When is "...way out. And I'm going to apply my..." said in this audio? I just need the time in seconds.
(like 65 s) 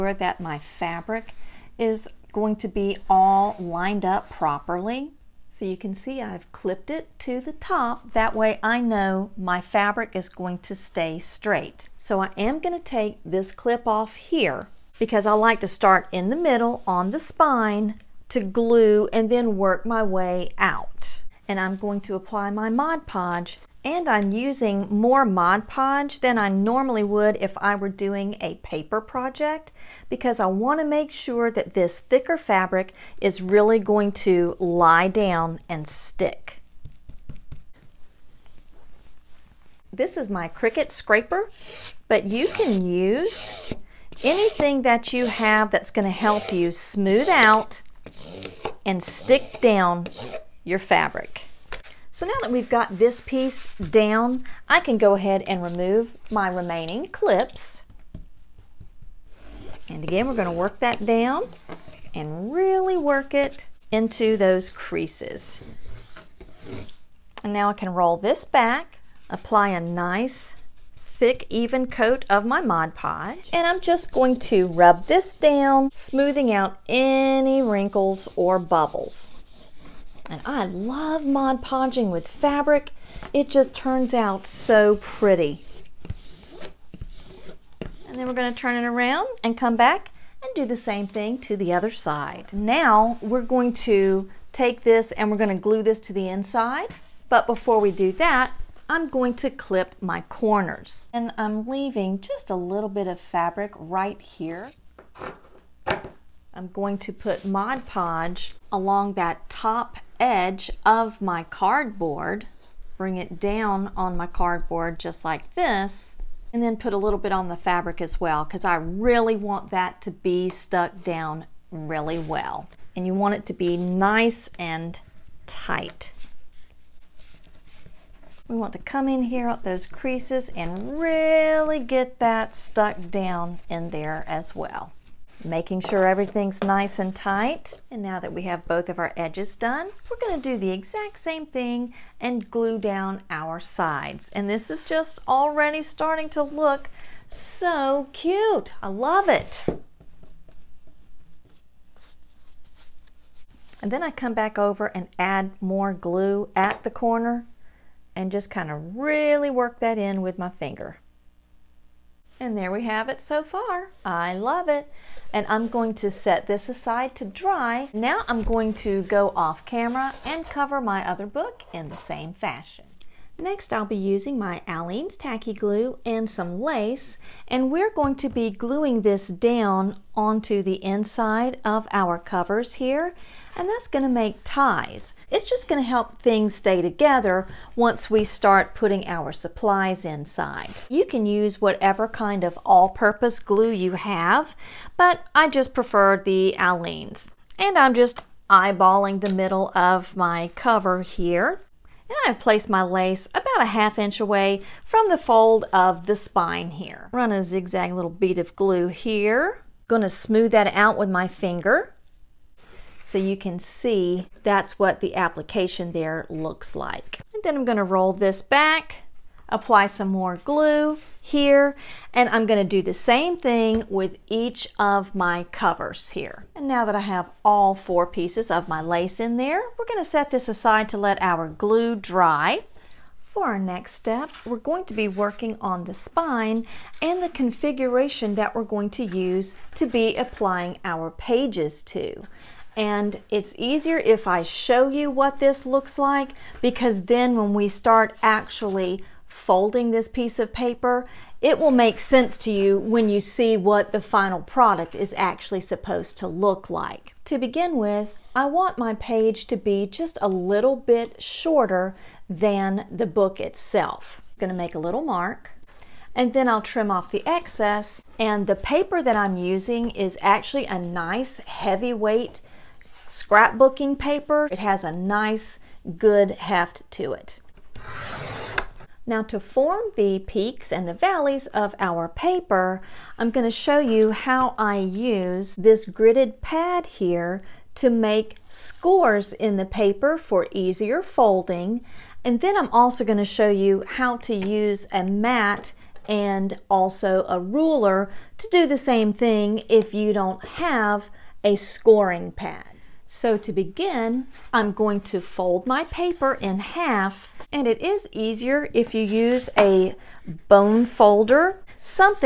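20 s.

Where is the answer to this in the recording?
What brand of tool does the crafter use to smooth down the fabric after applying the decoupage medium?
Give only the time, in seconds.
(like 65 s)
40 s.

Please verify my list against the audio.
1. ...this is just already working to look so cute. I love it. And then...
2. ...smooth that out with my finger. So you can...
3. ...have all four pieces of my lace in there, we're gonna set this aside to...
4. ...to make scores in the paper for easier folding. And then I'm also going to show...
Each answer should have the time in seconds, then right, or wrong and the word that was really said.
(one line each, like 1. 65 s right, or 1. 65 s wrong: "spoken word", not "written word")
1. 144 s wrong: "starting", not "working"
2. 210 s right
3. 227 s right
4. 287 s right.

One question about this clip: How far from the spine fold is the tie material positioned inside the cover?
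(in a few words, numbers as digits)
half inch.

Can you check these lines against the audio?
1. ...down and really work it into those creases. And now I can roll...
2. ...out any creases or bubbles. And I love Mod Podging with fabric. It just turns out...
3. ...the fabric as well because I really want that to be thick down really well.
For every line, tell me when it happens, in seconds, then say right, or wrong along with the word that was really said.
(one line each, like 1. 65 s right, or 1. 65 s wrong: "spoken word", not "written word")
1. 61 s right
2. 76 s wrong: "wrinkles", not "creases"
3. 117 s wrong: "stuck", not "thick".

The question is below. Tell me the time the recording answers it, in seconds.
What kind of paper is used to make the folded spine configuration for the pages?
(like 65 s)
271 s.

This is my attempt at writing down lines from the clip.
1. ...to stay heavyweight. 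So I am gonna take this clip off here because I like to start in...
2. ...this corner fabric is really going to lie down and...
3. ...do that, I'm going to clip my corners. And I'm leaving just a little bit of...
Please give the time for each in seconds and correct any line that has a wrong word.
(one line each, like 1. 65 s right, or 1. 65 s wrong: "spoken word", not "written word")
1. 10 s wrong: "straight", not "heavyweight"
2. 31 s wrong: "thicker", not "corner"
3. 97 s right.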